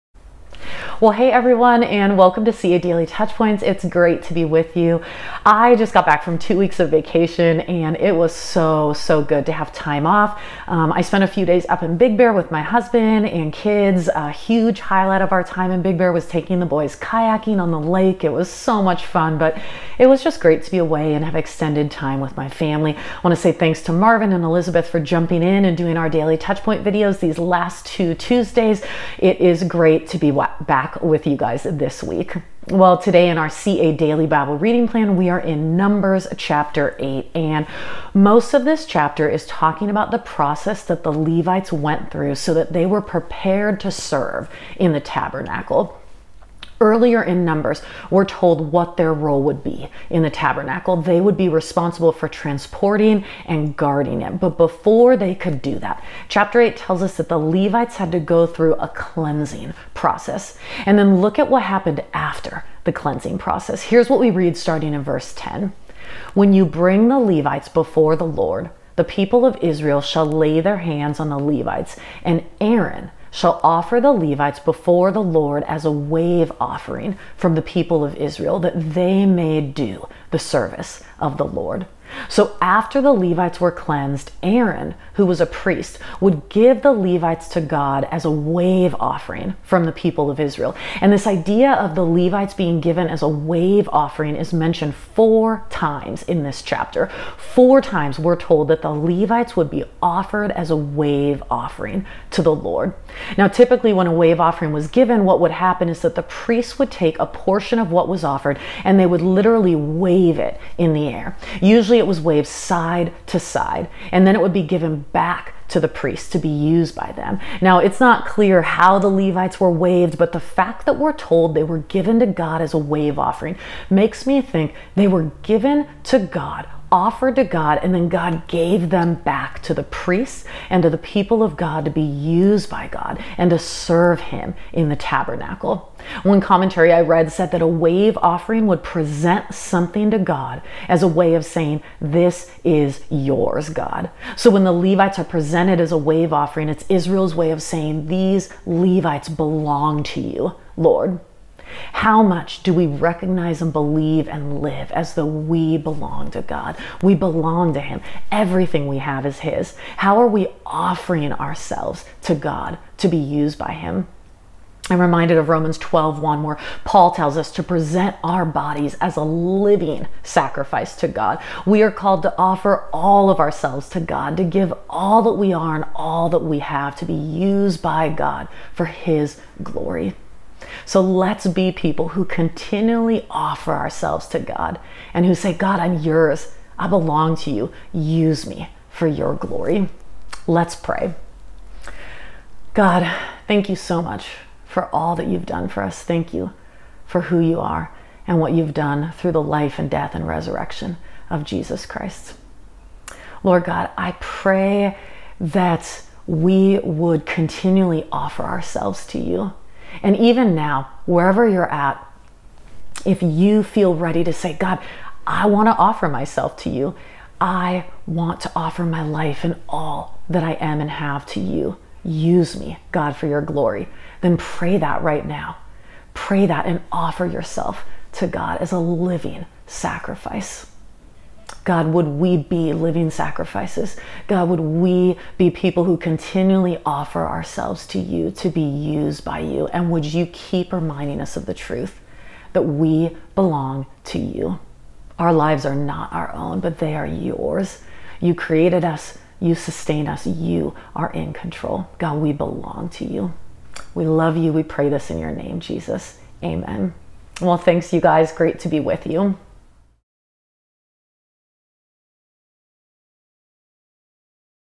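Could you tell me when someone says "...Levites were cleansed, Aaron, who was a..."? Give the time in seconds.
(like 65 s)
83 s.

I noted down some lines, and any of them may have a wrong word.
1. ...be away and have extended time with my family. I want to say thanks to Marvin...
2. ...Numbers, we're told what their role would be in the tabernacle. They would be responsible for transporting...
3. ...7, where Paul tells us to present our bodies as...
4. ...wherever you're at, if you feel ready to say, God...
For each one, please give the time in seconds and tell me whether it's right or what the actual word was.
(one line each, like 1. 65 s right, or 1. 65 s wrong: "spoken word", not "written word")
1. 20 s right
2. 47 s right
3. 166 s wrong: "1", not "7"
4. 211 s right.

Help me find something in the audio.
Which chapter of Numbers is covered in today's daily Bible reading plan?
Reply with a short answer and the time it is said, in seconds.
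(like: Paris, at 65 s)
8, at 35 s.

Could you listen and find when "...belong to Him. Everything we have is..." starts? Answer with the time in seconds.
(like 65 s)
157 s.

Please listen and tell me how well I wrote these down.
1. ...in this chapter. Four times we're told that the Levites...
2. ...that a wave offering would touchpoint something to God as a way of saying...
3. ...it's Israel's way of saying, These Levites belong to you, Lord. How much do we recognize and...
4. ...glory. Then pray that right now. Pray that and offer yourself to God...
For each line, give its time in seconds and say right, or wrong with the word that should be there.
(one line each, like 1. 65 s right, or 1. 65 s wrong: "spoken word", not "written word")
1. 96 s right
2. 137 s wrong: "present", not "touchpoint"
3. 146 s right
4. 223 s right.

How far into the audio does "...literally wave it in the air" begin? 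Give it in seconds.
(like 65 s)
109 s.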